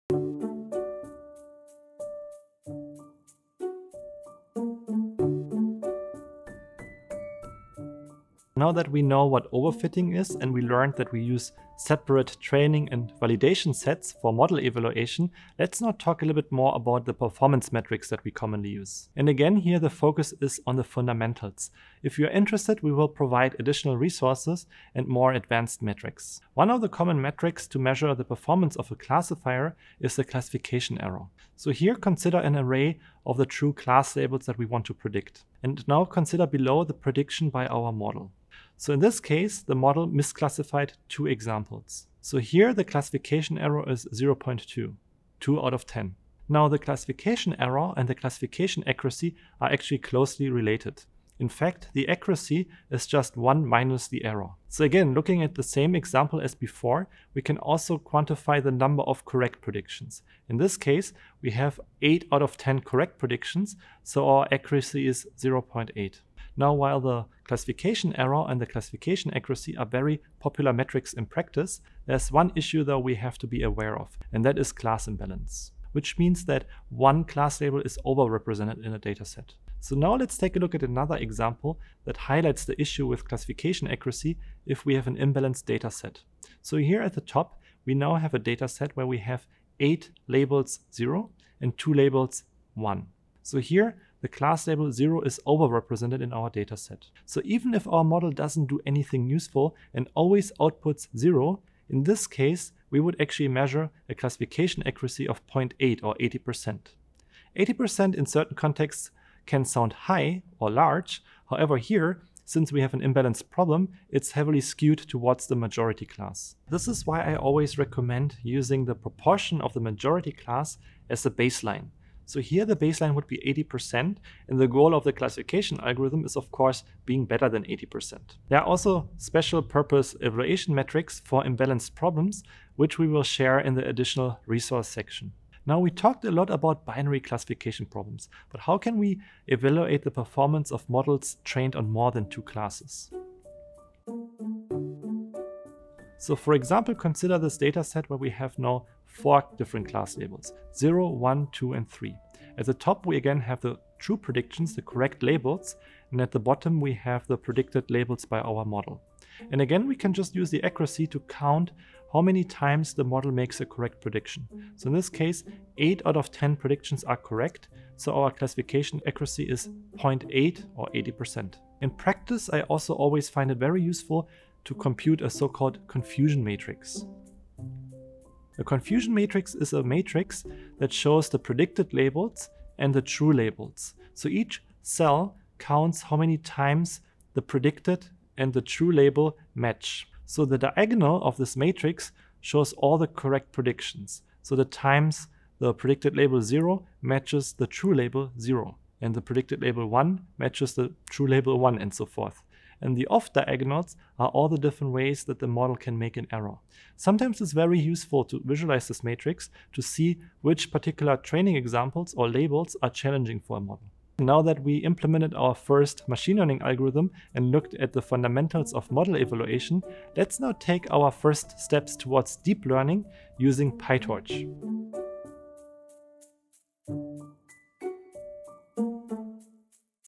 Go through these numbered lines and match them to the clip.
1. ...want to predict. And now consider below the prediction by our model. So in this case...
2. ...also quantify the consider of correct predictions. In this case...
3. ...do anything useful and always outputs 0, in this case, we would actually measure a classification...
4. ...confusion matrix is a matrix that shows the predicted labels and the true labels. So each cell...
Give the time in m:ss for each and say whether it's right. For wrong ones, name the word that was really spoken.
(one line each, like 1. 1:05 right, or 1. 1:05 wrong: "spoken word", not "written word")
1. 0:34 right
2. 0:57 wrong: "number", not "consider"
3. 1:38 right
4. 2:58 right.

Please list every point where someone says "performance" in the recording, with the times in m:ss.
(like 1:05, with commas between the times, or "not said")
0:17, 0:28, 2:20.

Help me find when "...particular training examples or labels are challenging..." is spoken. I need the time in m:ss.
3:30.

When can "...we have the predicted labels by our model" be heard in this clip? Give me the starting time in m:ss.
2:36.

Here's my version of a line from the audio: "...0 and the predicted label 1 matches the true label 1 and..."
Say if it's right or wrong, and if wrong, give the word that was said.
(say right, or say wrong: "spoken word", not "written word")
right.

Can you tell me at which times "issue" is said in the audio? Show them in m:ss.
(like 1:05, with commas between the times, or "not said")
1:12, 1:22.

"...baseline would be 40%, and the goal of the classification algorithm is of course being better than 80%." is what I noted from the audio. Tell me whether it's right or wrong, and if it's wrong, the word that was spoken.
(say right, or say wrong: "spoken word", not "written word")
wrong: "80", not "40".